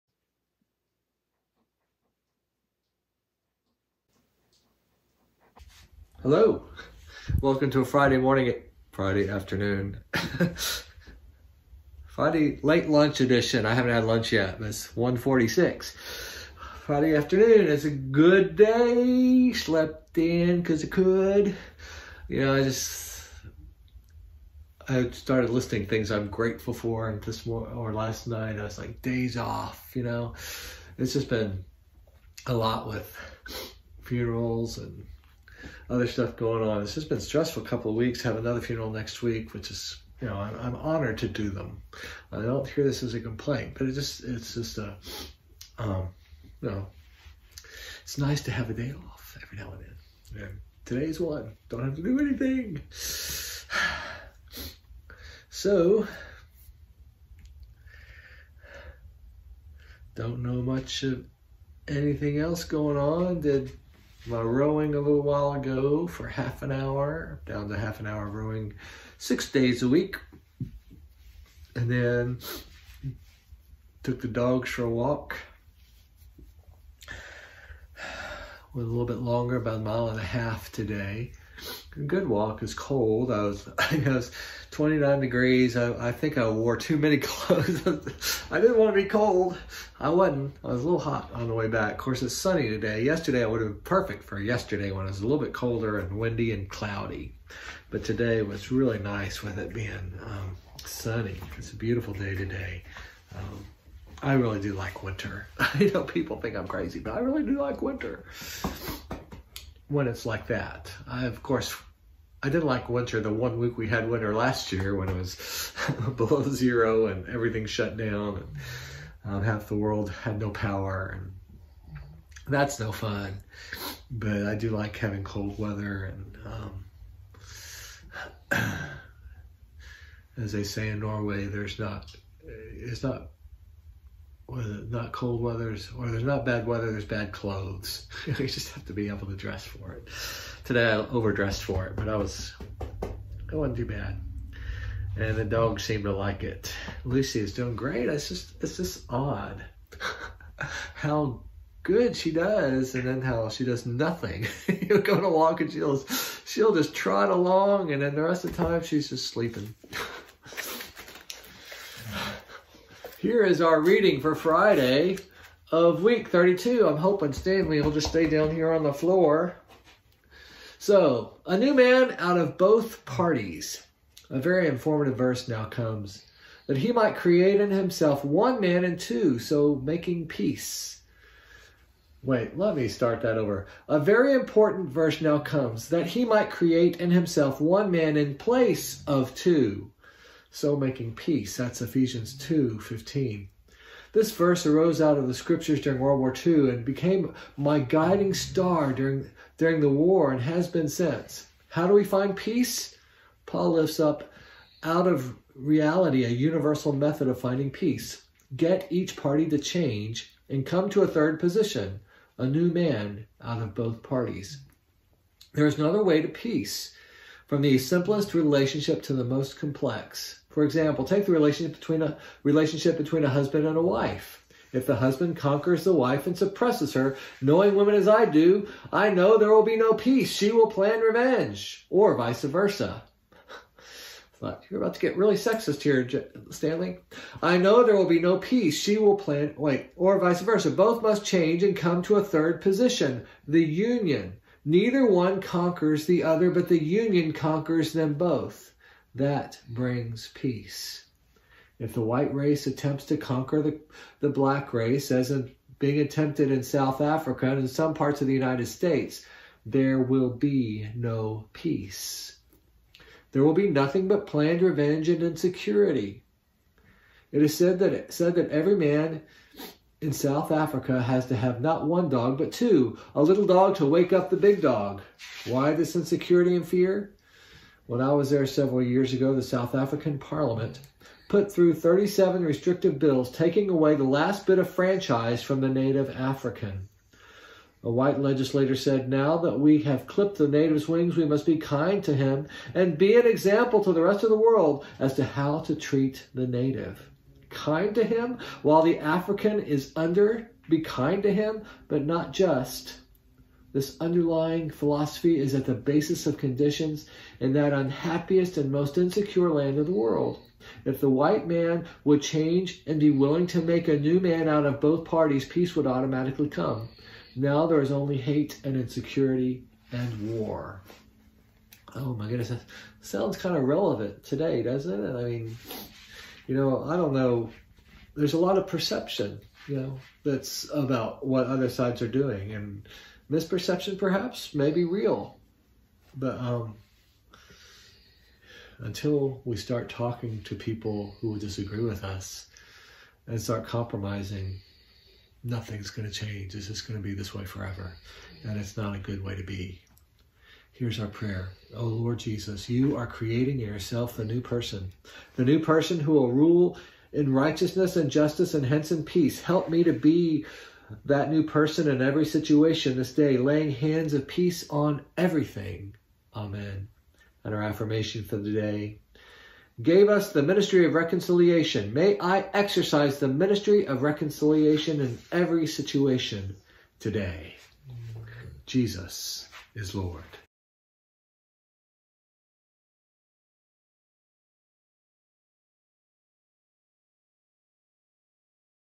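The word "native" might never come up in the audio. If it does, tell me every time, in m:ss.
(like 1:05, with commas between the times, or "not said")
4:45, 4:50, 4:56.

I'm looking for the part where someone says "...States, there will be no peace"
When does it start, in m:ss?
4:18.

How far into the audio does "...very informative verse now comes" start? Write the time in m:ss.
2:54.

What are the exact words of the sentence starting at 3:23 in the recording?
Paul lifts up out of reality a universal method of finding peace.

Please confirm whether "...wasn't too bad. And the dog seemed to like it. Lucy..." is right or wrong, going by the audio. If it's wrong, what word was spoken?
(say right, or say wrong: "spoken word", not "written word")
right.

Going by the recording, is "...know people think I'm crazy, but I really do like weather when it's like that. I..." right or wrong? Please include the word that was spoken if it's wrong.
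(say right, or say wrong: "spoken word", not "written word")
wrong: "winter", not "weather".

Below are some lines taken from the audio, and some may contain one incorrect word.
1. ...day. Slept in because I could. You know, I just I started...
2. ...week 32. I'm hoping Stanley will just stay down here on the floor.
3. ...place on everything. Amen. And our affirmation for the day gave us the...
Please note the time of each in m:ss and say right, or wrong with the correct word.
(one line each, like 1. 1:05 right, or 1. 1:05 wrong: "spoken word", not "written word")
1. 0:18 right
2. 2:46 right
3. 6:04 wrong: "peace", not "place".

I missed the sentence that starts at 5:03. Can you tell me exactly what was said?
This underlying philosophy is at the basis of conditions in that unhappiest and most insecure land of the world.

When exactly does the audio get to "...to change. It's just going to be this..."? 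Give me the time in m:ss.
5:46.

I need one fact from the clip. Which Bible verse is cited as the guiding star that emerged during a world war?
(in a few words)
Ephesians 2:15.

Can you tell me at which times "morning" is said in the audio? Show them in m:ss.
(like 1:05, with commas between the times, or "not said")
0:08, 0:27.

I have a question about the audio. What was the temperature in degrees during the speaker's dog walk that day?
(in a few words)
29.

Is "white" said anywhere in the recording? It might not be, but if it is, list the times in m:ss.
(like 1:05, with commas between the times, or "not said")
4:12, 4:47, 5:11.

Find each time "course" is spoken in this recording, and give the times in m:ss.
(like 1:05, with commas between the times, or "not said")
1:31, 1:51.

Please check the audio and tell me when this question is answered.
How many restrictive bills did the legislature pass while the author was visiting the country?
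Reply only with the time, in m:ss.
4:41.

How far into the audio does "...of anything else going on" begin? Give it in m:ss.
1:01.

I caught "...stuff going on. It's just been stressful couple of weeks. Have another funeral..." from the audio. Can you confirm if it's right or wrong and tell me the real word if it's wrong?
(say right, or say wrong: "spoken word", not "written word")
right.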